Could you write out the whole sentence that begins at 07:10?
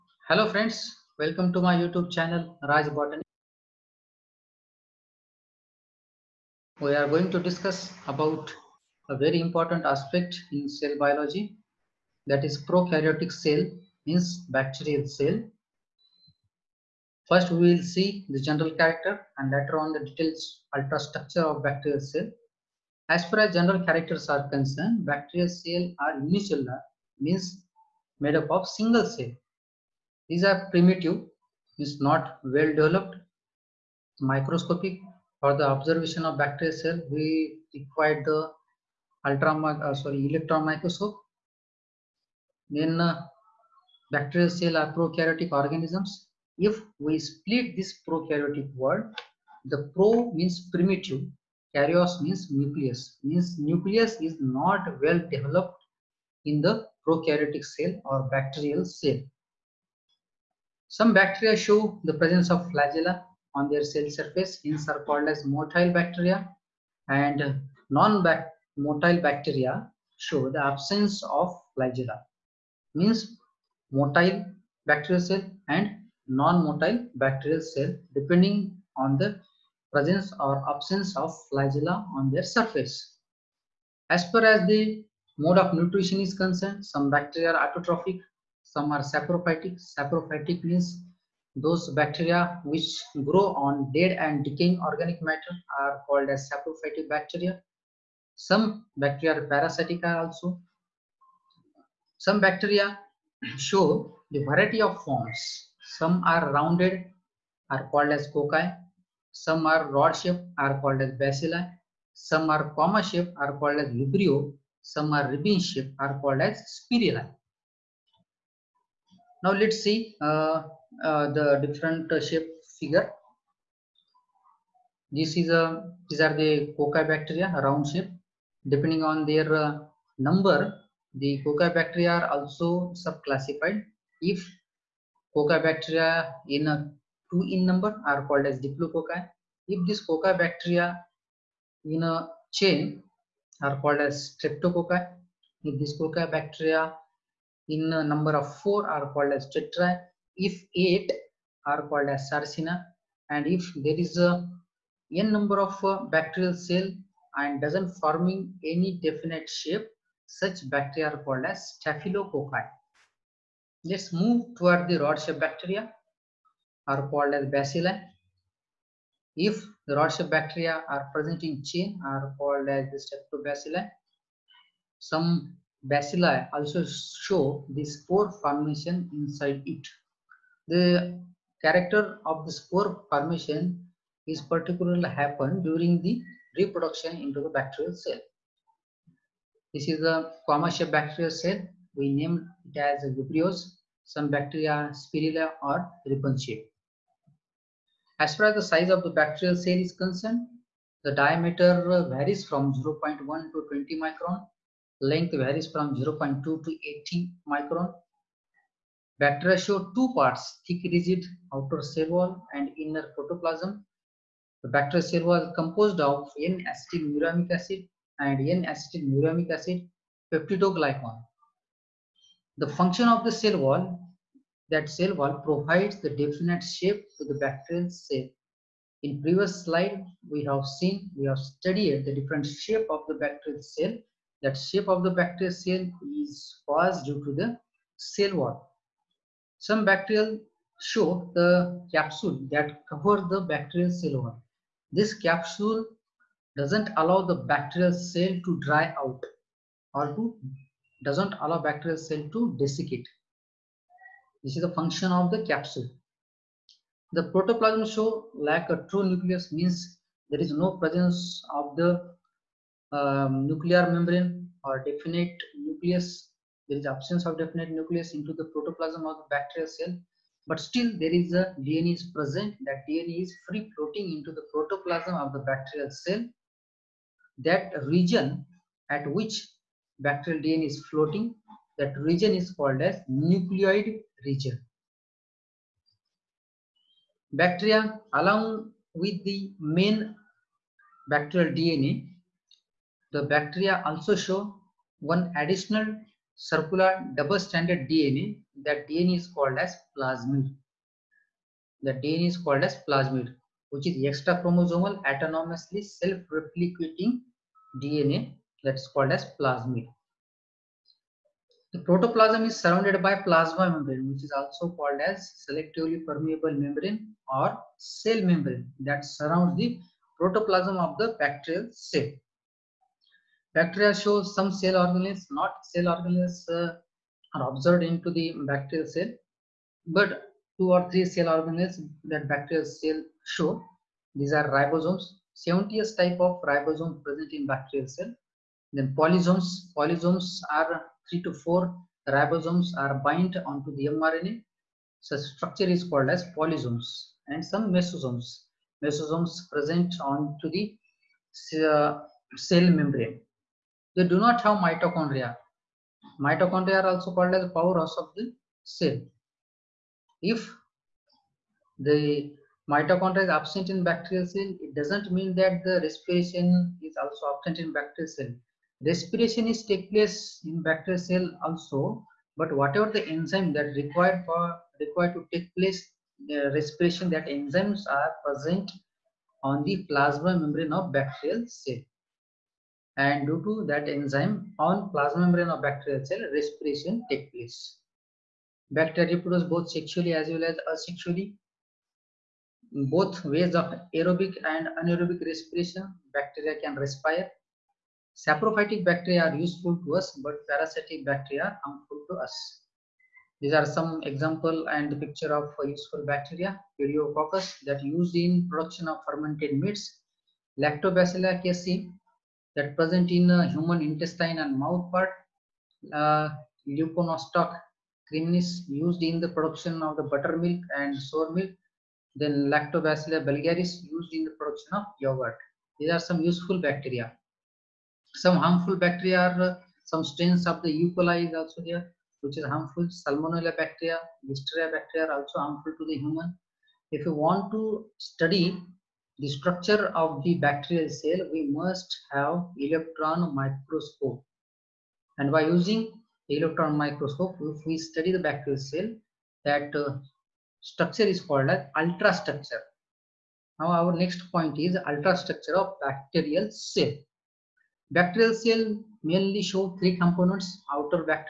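coli is also here, which is harmful.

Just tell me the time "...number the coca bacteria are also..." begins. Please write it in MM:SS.
02:10.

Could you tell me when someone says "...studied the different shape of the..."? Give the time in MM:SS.
03:51.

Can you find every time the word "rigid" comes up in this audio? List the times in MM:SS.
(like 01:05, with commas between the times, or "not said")
03:30.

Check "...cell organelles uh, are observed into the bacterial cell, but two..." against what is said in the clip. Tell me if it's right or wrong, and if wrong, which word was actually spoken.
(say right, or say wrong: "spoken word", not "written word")
right.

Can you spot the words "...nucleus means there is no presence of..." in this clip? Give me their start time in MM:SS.
04:19.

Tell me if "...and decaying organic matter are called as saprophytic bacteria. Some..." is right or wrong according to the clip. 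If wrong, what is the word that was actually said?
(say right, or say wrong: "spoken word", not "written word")
right.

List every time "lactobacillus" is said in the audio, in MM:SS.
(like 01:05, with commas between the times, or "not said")
06:50, 07:02.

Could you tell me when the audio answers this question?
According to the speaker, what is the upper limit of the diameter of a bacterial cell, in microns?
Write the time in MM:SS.
03:23.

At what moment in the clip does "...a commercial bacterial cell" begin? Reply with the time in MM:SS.
03:10.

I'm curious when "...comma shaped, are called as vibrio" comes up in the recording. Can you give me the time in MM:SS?
01:52.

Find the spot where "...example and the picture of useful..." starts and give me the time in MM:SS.
06:44.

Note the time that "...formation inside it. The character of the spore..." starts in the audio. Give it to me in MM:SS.
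02:58.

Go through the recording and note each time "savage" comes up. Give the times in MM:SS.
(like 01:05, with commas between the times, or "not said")
not said.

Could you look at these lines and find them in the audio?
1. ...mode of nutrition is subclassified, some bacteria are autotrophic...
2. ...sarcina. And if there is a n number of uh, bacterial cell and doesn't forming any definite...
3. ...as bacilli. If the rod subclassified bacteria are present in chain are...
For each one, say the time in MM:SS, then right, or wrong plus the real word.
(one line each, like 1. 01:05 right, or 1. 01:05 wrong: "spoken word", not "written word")
1. 01:25 wrong: "concerned", not "subclassified"
2. 02:32 right
3. 02:47 wrong: "shaped", not "subclassified".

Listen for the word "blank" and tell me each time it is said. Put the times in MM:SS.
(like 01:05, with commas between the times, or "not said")
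not said.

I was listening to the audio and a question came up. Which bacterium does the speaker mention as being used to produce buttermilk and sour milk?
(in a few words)
Leuconostoc cremoris.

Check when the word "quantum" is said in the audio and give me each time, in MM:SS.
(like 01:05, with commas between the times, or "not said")
not said.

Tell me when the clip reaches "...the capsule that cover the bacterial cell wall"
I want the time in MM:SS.
04:01.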